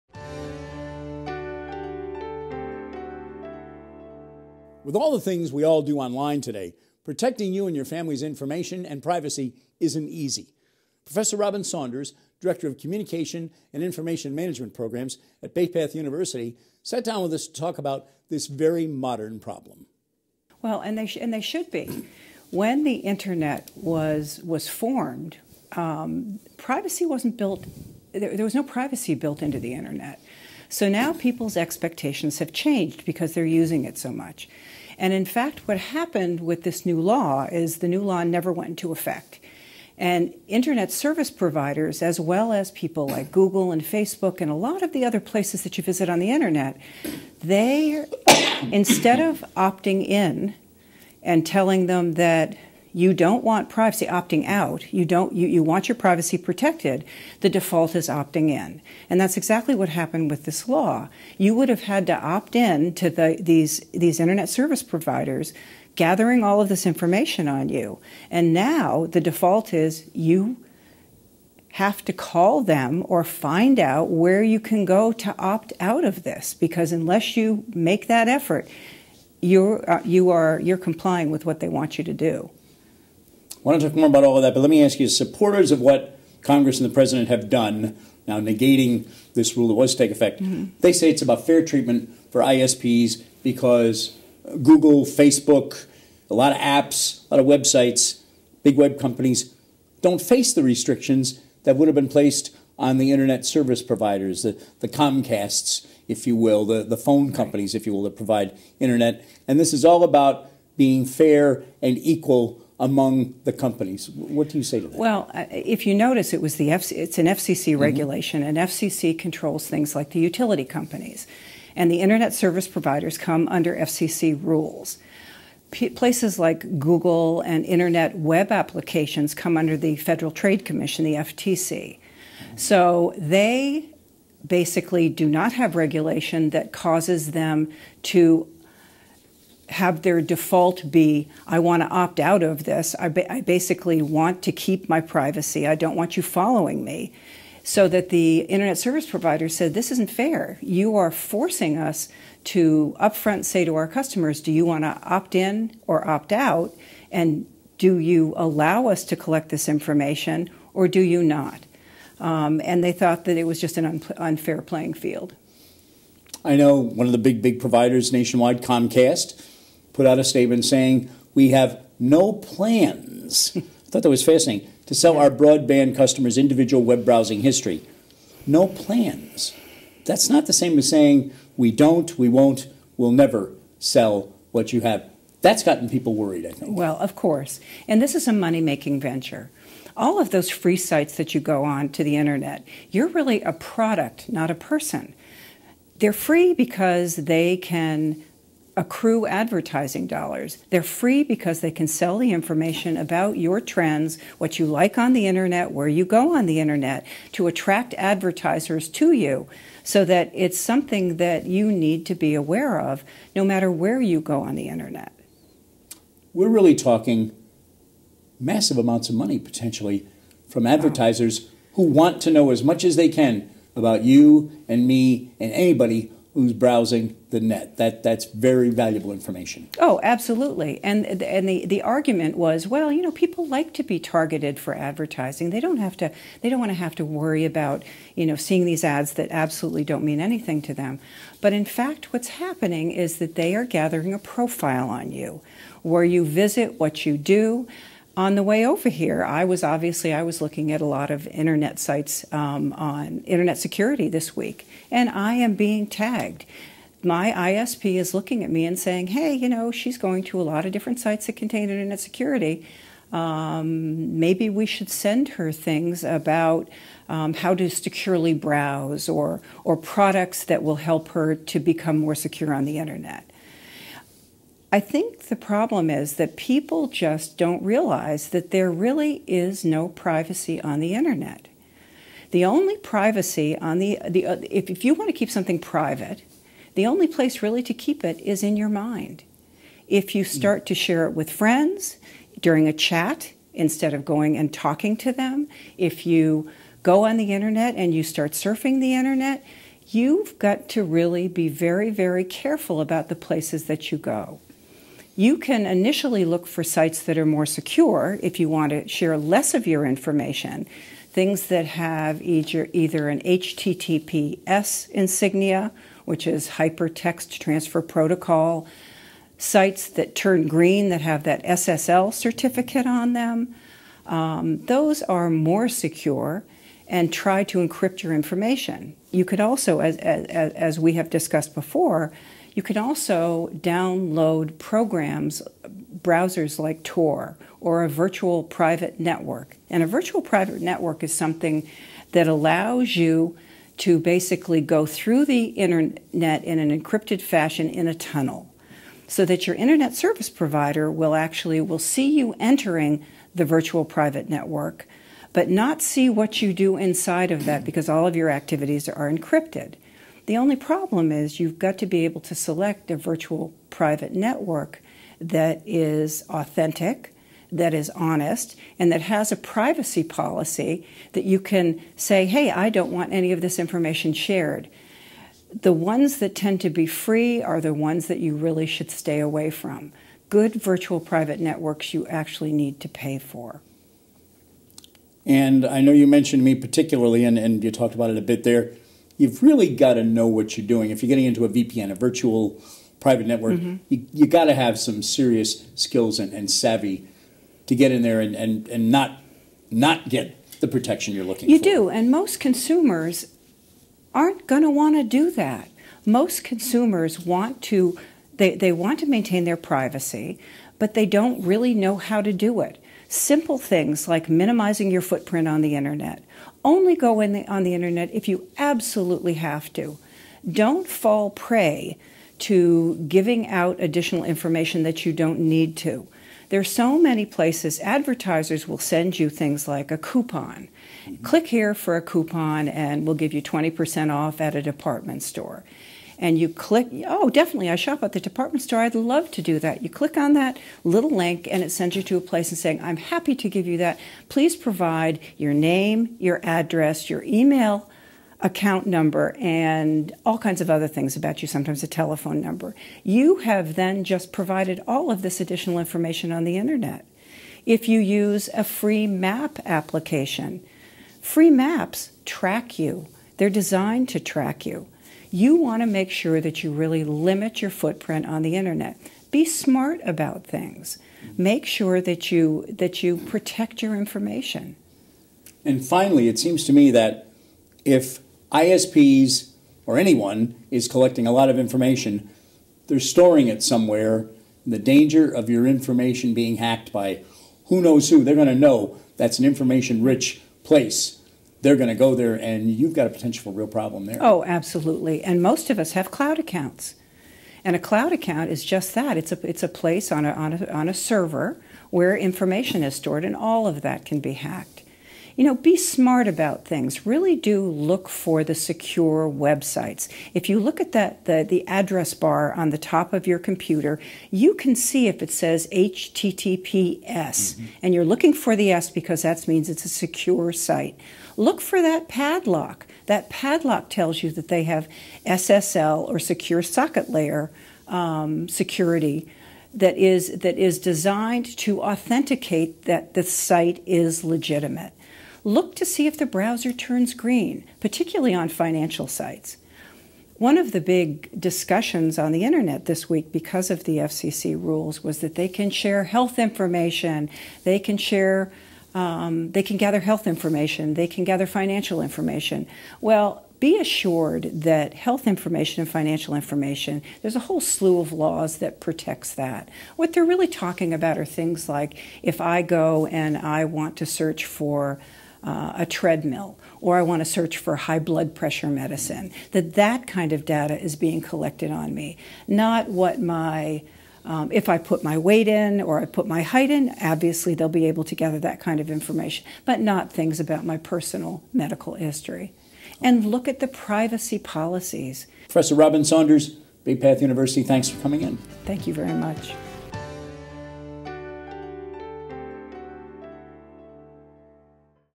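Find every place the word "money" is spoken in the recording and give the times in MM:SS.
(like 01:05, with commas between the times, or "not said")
03:08, 03:39.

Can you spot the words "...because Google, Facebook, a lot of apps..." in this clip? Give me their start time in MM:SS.
01:33.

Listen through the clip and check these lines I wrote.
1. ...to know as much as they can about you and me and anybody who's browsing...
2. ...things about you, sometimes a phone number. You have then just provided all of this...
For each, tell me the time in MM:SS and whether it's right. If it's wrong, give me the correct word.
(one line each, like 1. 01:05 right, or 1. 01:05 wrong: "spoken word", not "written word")
1. 03:42 right
2. 07:30 wrong: "telephone", not "phone".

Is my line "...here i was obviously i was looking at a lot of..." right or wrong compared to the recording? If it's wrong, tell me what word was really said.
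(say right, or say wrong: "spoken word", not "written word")
right.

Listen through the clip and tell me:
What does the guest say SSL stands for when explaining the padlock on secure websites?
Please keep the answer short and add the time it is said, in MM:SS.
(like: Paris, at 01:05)
secure socket layer, at 08:46.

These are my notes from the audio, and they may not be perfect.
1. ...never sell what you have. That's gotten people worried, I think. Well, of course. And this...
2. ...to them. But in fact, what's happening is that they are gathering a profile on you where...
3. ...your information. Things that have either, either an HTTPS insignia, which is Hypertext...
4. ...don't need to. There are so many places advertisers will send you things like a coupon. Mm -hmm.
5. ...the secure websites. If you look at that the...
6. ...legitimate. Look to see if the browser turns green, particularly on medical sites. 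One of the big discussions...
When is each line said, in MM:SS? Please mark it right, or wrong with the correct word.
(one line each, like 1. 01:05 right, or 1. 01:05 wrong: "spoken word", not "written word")
1. 03:03 right
2. 04:00 right
3. 05:09 right
4. 07:05 right
5. 08:28 right
6. 08:54 wrong: "financial", not "medical".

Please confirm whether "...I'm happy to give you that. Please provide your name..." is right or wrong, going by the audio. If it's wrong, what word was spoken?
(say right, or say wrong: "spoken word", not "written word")
right.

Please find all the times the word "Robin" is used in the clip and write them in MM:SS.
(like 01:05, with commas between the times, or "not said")
00:11, 09:45.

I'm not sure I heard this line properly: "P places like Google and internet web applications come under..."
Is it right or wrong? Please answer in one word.
right.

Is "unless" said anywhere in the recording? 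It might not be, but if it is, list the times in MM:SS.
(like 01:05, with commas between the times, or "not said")
01:16.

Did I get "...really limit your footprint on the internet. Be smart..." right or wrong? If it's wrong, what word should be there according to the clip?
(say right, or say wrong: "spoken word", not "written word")
right.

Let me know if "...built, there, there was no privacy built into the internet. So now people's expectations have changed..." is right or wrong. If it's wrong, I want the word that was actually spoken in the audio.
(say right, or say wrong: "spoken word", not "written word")
right.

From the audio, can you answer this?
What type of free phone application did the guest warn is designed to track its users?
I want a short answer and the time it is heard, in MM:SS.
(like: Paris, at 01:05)
maps, at 07:41.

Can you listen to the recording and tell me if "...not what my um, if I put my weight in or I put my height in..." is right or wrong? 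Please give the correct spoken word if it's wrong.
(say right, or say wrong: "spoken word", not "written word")
right.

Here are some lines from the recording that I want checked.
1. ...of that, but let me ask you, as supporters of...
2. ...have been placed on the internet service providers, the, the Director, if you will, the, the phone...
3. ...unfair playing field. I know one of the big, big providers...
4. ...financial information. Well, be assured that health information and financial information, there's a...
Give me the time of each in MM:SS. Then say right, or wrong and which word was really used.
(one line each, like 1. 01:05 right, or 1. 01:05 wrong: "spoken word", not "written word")
1. 01:24 right
2. 01:41 wrong: "Comcasts", not "Director"
3. 02:44 right
4. 09:11 right.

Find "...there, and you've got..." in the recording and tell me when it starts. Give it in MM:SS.
08:12.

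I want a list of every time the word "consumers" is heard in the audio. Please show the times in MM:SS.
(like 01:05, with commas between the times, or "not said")
06:42, 06:46.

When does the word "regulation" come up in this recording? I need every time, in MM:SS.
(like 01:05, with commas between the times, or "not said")
01:57, 02:15.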